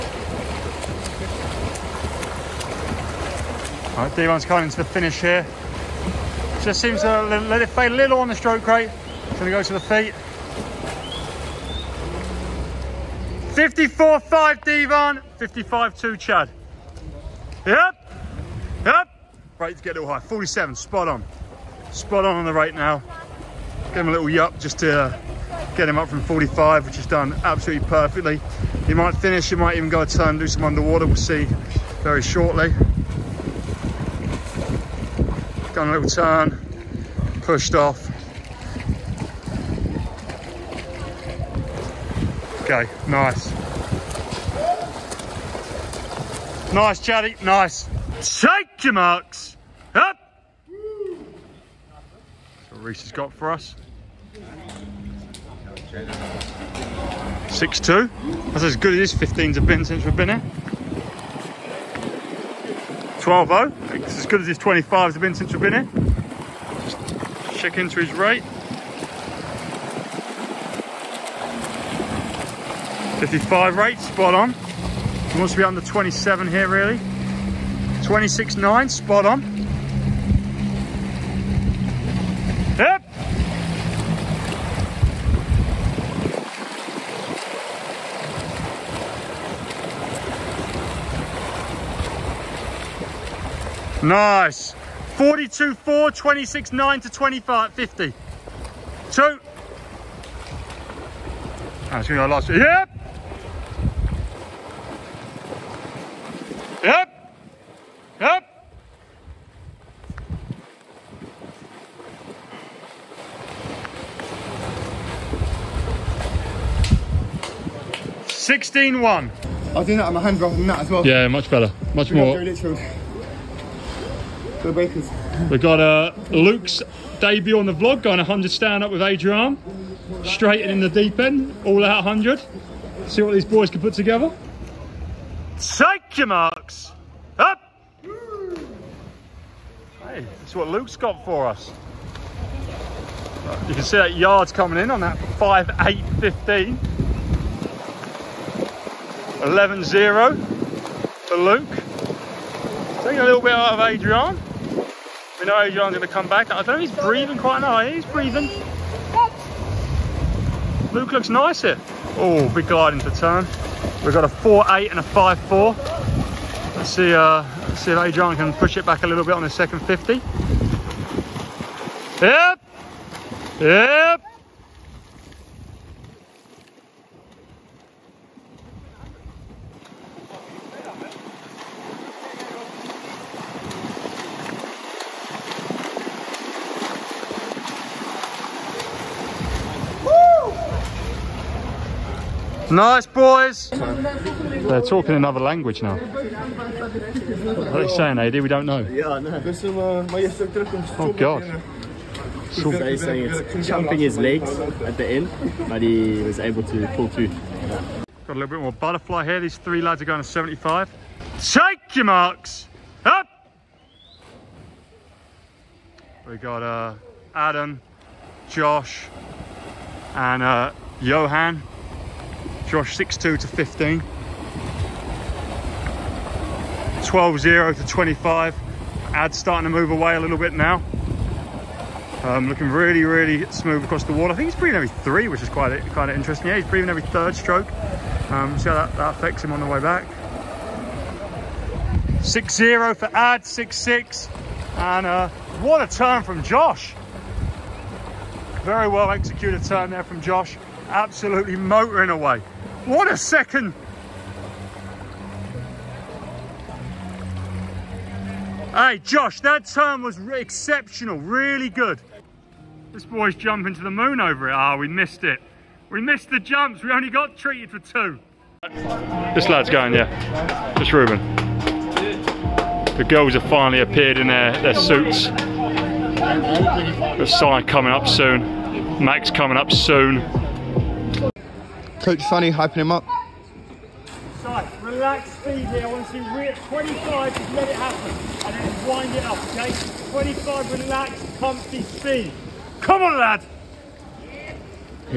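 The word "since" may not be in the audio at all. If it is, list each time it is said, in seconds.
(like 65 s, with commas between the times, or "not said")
59 s, 65 s.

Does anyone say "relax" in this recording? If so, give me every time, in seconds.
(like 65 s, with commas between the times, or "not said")
284 s, 290 s.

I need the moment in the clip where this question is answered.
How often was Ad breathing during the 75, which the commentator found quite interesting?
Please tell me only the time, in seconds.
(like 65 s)
236 s.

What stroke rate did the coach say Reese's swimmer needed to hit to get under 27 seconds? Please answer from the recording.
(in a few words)
55.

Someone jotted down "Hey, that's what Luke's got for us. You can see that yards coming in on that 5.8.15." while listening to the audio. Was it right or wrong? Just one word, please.
right.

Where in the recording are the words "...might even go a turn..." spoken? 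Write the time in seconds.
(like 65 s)
29 s.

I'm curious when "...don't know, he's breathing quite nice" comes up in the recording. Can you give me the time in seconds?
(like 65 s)
156 s.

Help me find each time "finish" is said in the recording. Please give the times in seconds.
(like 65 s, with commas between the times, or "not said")
4 s, 29 s.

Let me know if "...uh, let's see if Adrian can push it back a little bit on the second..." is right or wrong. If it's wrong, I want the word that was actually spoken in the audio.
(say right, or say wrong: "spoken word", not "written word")
right.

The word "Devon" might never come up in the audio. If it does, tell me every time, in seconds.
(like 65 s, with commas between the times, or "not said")
14 s.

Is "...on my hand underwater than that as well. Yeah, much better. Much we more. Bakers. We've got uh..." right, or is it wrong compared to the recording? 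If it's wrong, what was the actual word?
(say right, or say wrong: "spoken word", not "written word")
wrong: "rather", not "underwater".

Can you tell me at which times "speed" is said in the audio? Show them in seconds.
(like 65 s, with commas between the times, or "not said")
285 s, 291 s.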